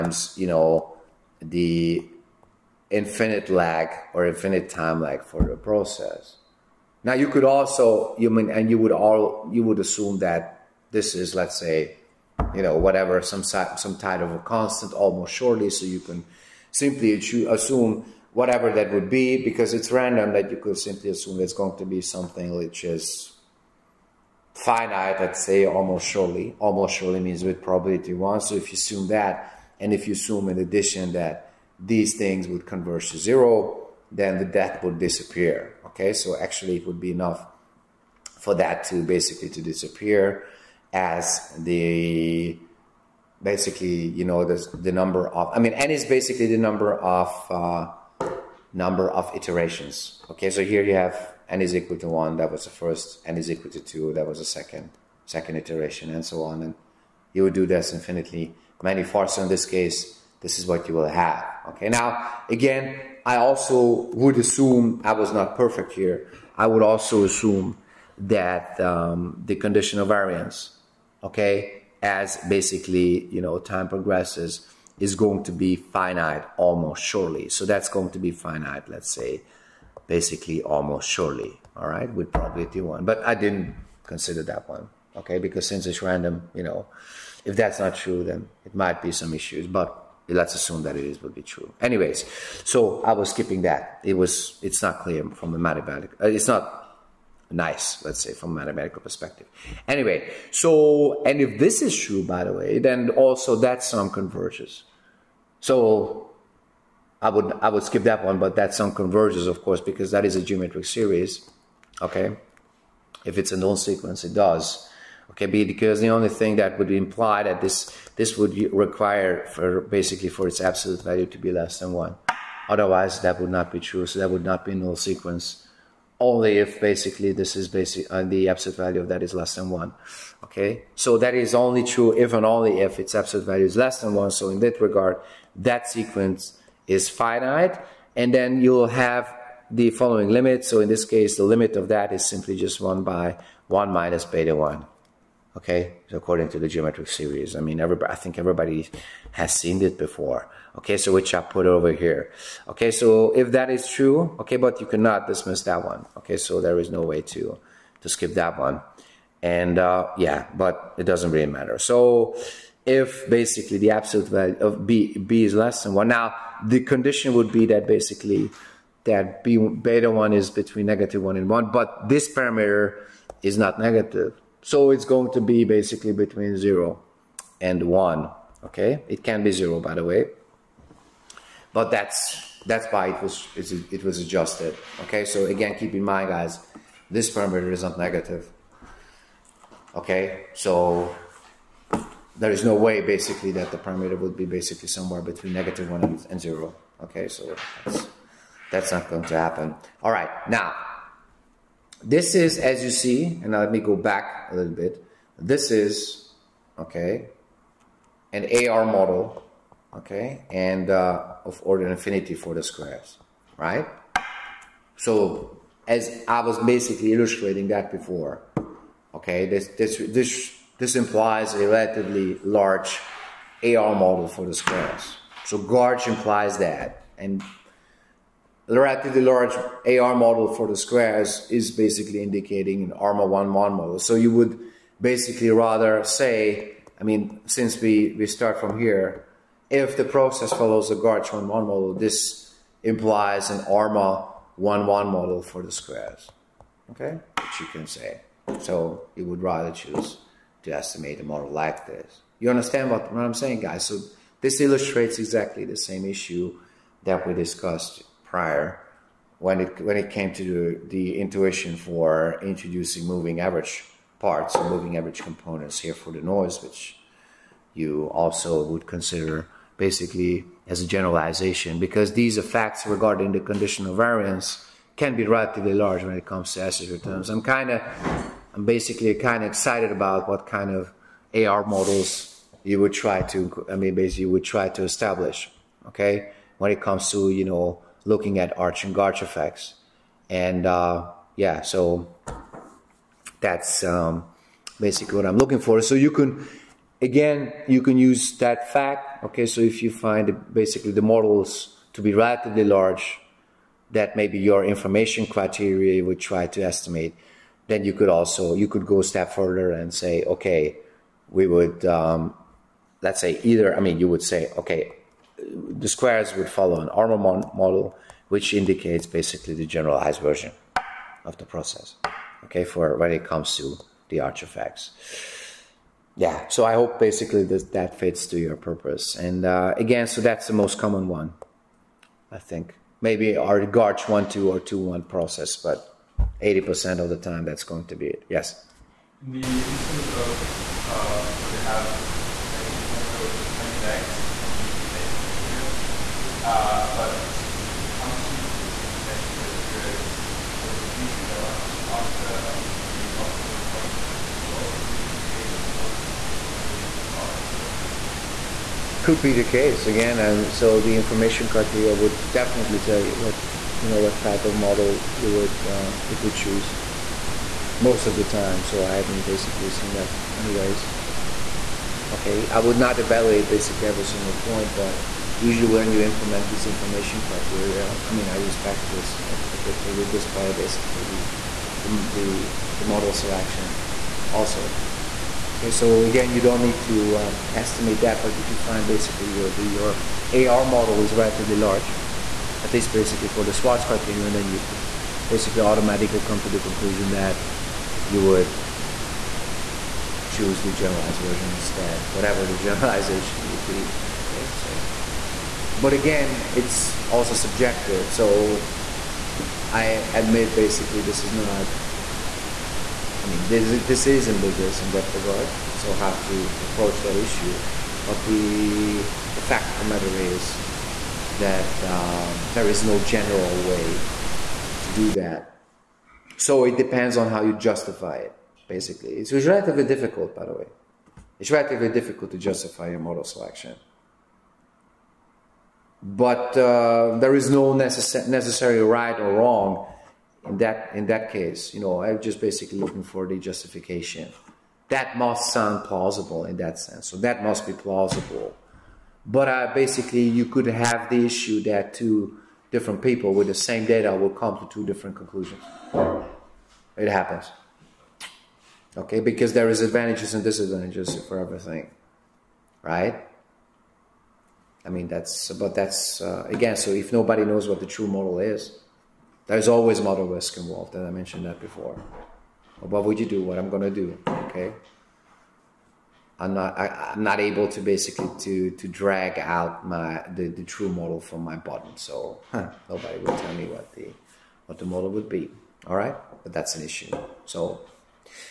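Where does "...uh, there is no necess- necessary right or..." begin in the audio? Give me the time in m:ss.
7:16.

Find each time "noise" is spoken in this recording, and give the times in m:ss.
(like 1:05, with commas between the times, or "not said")
4:26.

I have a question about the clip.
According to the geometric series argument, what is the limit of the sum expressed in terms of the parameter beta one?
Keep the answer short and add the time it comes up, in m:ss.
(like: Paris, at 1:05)
1/(1 - beta one), at 2:22.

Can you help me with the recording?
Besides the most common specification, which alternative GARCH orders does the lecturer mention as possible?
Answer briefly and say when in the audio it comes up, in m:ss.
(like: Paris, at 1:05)
GARCH(1,2) or (2,1), at 5:33.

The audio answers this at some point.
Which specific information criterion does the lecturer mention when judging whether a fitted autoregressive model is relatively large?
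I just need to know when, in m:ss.
6:33.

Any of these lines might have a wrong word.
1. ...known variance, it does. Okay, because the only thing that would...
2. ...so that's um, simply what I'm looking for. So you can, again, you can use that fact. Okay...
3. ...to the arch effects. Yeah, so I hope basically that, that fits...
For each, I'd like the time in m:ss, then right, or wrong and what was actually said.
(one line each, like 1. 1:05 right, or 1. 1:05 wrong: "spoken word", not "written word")
1. 1:53 wrong: "sequence", not "variance"
2. 4:51 wrong: "basically", not "simply"
3. 5:23 right.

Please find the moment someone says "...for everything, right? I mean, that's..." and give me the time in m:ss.
7:41.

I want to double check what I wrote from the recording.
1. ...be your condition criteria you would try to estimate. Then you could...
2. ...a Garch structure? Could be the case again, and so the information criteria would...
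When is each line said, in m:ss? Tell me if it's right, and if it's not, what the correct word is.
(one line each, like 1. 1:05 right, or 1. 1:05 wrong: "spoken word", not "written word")
1. 5:04 wrong: "information", not "condition"
2. 5:56 right.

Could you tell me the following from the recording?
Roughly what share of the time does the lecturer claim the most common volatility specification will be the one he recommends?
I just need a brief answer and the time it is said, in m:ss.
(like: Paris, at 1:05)
80%, at 5:36.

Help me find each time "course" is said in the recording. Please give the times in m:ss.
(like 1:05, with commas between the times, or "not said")
1:49.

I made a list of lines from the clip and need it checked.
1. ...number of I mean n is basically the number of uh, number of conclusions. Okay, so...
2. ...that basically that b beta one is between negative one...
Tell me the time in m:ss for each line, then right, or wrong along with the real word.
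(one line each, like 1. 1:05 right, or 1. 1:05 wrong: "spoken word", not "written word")
1. 0:44 wrong: "iterations", not "conclusions"
2. 2:47 right.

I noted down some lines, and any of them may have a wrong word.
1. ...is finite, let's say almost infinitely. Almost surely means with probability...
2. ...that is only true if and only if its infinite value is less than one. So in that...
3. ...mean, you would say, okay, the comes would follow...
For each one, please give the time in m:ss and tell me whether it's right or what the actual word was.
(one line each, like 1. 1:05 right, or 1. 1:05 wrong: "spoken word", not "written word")
1. 0:22 wrong: "surely", not "infinitely"
2. 2:11 wrong: "absolute", not "infinite"
3. 5:13 wrong: "squares", not "comes".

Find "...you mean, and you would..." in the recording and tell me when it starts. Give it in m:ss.
0:08.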